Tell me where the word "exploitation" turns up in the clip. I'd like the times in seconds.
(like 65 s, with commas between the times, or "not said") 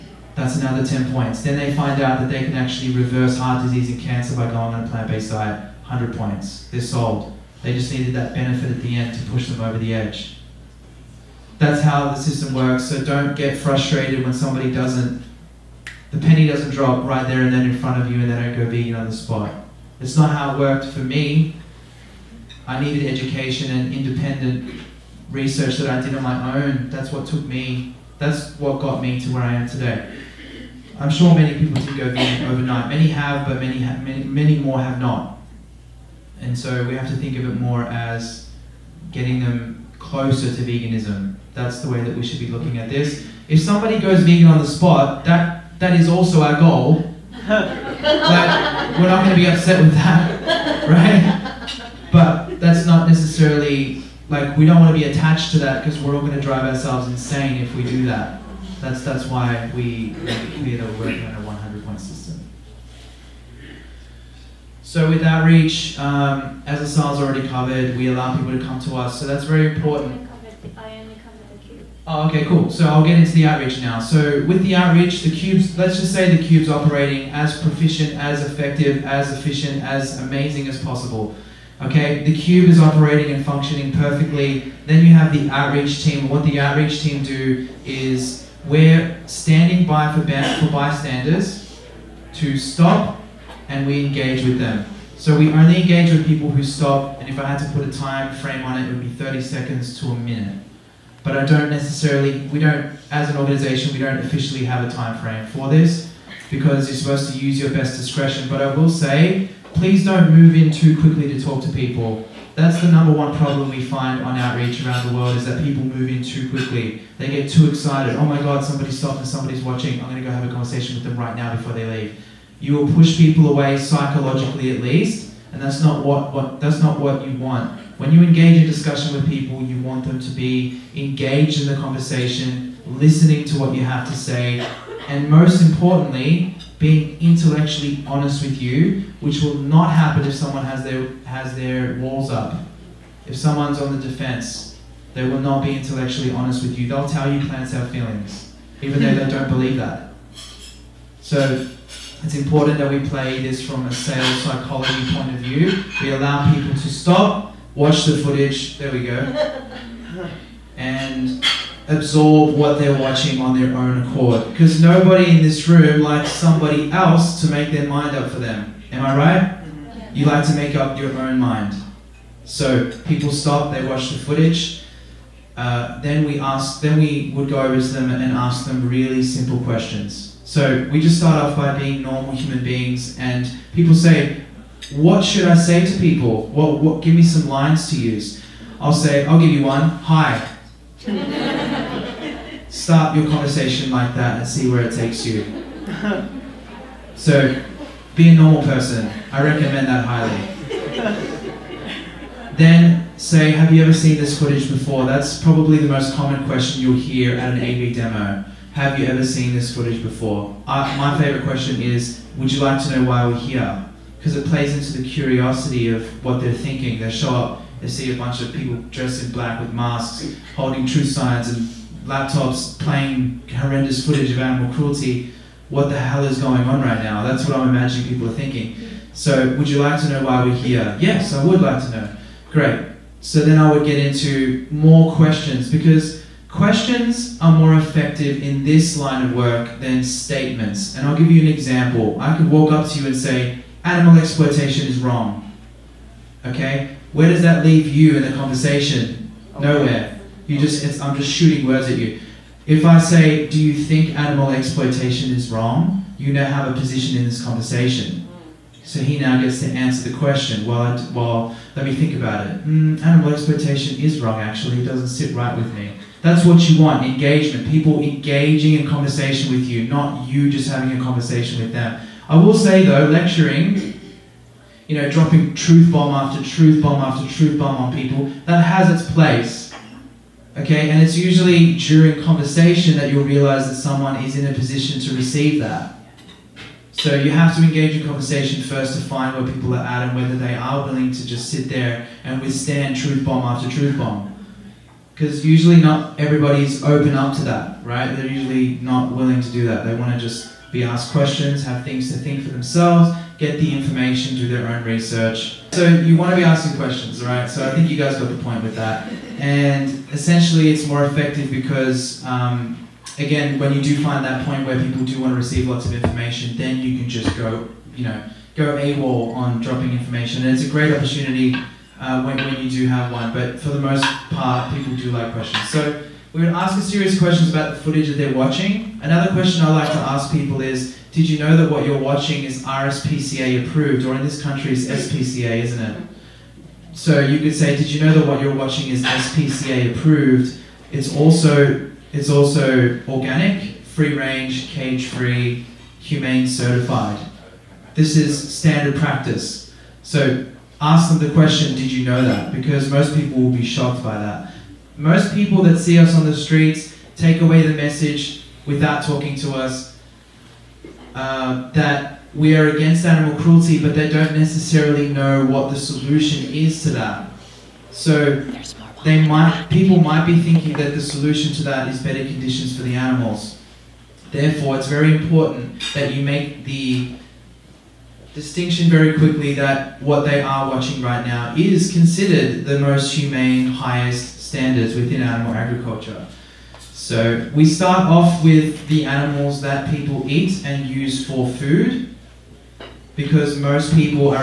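244 s, 254 s, 263 s.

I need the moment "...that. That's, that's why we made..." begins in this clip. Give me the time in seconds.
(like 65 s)
58 s.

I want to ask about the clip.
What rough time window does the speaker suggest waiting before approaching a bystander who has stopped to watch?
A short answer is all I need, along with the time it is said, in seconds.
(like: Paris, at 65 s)
30 seconds to a minute, at 99 s.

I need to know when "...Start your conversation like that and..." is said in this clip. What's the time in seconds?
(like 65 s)
192 s.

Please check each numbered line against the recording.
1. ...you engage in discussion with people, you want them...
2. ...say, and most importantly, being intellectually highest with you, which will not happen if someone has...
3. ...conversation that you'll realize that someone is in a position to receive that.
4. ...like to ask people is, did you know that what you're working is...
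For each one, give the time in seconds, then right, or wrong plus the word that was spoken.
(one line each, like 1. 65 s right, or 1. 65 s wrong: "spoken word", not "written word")
1. 128 s right
2. 134 s wrong: "honest", not "highest"
3. 282 s right
4. 329 s wrong: "watching", not "working".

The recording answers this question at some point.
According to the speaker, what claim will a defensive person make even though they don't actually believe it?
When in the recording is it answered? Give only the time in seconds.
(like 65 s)
147 s.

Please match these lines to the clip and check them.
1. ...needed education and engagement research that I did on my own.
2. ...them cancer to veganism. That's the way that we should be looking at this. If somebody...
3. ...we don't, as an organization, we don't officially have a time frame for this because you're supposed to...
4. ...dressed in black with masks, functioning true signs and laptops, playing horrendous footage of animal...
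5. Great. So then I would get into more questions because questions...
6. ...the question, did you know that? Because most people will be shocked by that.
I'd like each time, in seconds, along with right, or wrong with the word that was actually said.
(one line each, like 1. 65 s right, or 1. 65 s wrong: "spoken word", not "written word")
1. 22 s wrong: "independent", not "engagement"
2. 39 s wrong: "closer", not "cancer"
3. 102 s right
4. 218 s wrong: "holding", not "functioning"
5. 232 s right
6. 351 s right.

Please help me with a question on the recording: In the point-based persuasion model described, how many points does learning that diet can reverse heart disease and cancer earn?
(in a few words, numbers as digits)
100.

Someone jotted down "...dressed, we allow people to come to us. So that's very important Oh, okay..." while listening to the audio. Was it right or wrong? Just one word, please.
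wrong.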